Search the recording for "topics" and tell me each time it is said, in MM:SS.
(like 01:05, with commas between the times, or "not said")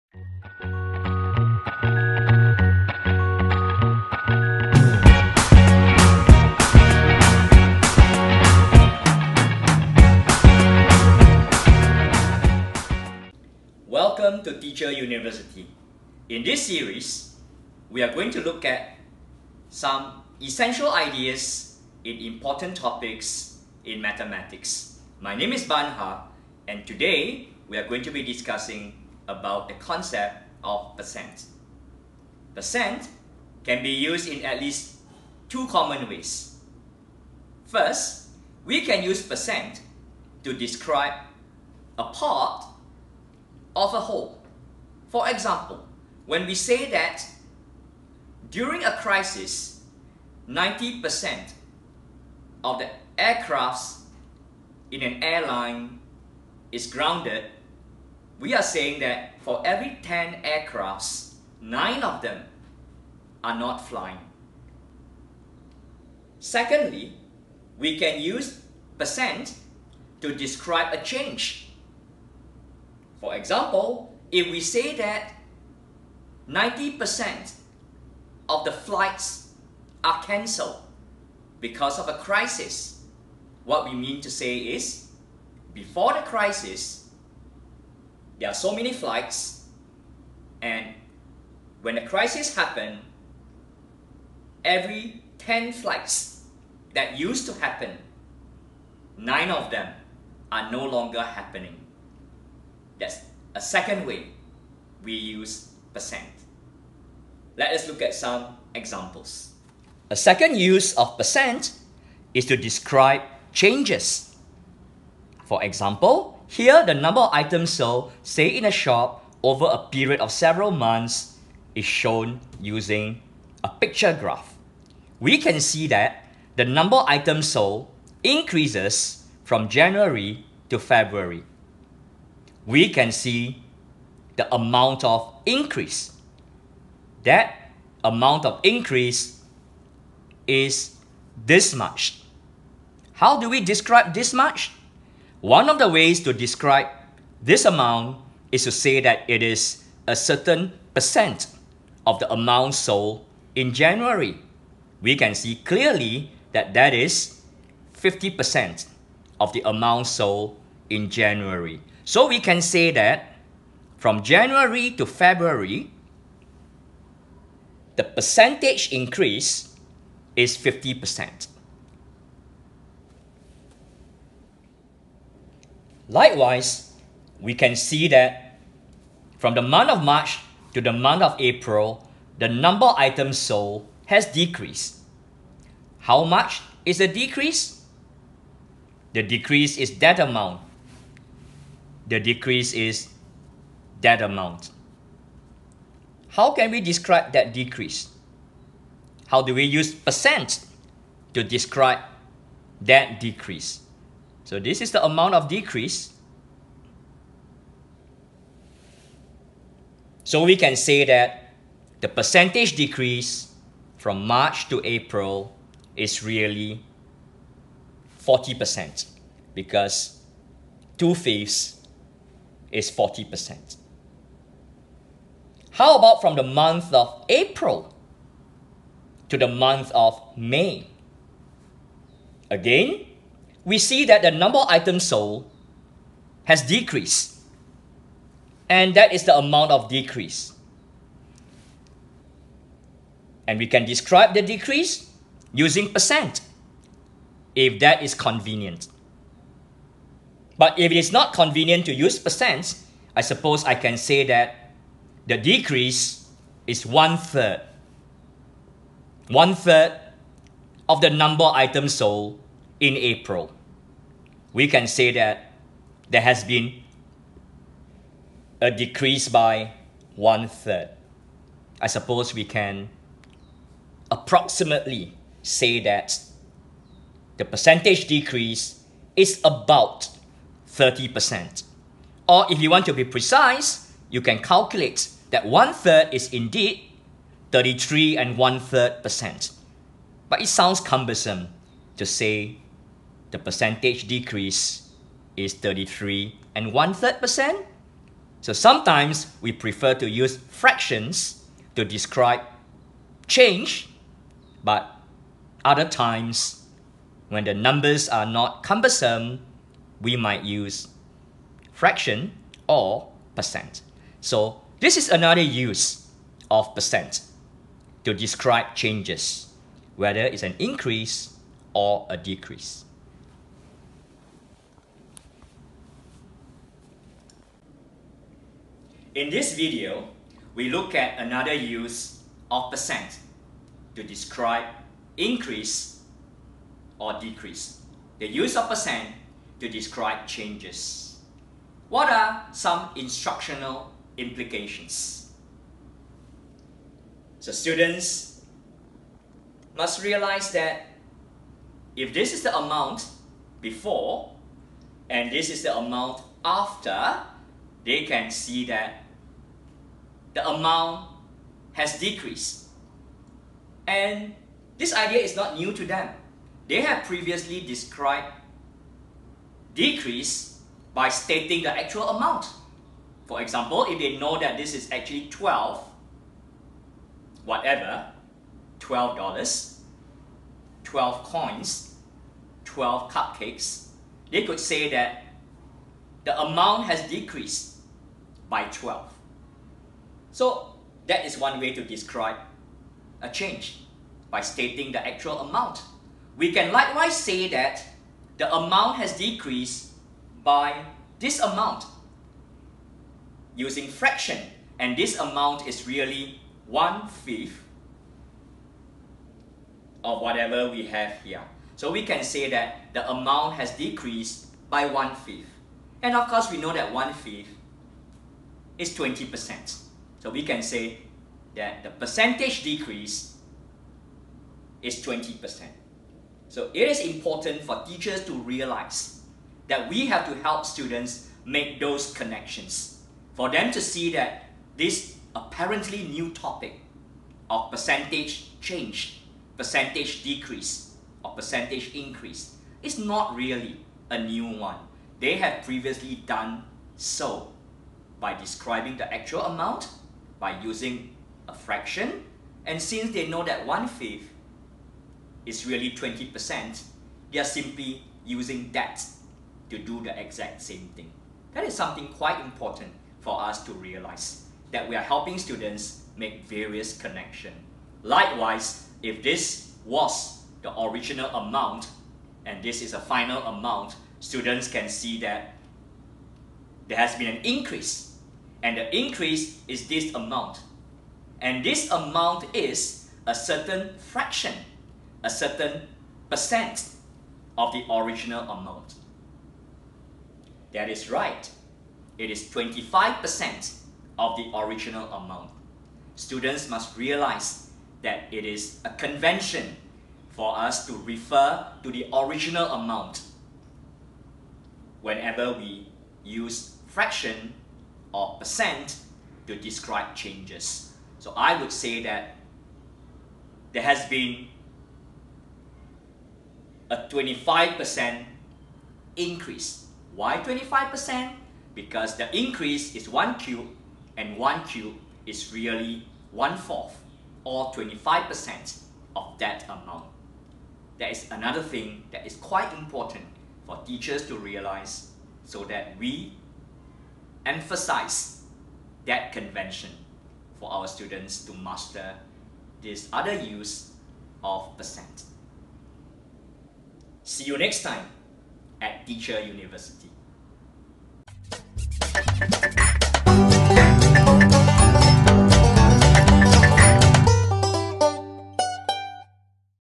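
00:22, 07:16.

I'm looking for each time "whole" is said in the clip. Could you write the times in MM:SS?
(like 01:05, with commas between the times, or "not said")
00:43.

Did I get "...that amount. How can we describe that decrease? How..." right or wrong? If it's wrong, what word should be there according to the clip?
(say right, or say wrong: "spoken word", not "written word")
right.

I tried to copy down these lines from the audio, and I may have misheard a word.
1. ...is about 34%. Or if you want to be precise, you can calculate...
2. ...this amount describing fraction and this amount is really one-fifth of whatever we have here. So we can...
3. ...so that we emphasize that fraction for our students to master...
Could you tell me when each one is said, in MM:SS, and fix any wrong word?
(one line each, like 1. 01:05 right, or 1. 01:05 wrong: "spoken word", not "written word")
1. 04:39 wrong: "30", not "34"
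2. 06:41 wrong: "using", not "describing"
3. 08:55 wrong: "convention", not "fraction".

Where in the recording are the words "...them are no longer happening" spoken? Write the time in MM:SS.
01:39.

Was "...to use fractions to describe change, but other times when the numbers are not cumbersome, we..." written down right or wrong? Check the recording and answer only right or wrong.
right.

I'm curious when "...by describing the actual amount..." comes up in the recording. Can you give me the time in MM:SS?
07:28.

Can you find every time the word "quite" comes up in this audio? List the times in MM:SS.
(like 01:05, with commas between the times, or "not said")
07:42, 08:52.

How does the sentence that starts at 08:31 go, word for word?
So I would say that there has been a 25% increase.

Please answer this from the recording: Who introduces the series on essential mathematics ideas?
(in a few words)
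Ban Har.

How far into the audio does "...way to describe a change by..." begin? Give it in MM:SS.
06:31.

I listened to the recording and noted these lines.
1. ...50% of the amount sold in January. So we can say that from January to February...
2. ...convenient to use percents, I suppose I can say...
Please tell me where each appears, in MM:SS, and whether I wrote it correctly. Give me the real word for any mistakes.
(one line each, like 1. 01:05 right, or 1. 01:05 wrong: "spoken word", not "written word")
1. 02:37 right
2. 04:11 right.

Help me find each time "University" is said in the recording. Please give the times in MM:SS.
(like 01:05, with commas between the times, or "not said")
00:14, 09:09.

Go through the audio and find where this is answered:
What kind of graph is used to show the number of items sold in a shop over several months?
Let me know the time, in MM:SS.
02:03.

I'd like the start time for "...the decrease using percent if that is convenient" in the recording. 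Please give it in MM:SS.
04:04.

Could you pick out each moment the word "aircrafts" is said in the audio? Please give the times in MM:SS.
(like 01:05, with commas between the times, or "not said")
00:53, 01:00.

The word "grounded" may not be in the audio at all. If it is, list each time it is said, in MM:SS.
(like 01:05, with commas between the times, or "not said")
00:56.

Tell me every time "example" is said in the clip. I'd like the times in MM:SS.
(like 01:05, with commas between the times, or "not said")
00:45, 01:13, 01:48, 01:55, 06:13.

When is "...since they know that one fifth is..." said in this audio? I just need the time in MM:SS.
07:32.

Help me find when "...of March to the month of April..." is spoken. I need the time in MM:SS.
02:59.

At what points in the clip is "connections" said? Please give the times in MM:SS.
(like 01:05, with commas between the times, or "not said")
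07:12, 07:46.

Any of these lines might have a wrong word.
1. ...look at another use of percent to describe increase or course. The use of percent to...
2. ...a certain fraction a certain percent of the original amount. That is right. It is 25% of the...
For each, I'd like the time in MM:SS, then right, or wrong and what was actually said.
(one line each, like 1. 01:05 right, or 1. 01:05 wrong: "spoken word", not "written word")
1. 05:30 wrong: "decrease", not "course"
2. 08:03 right.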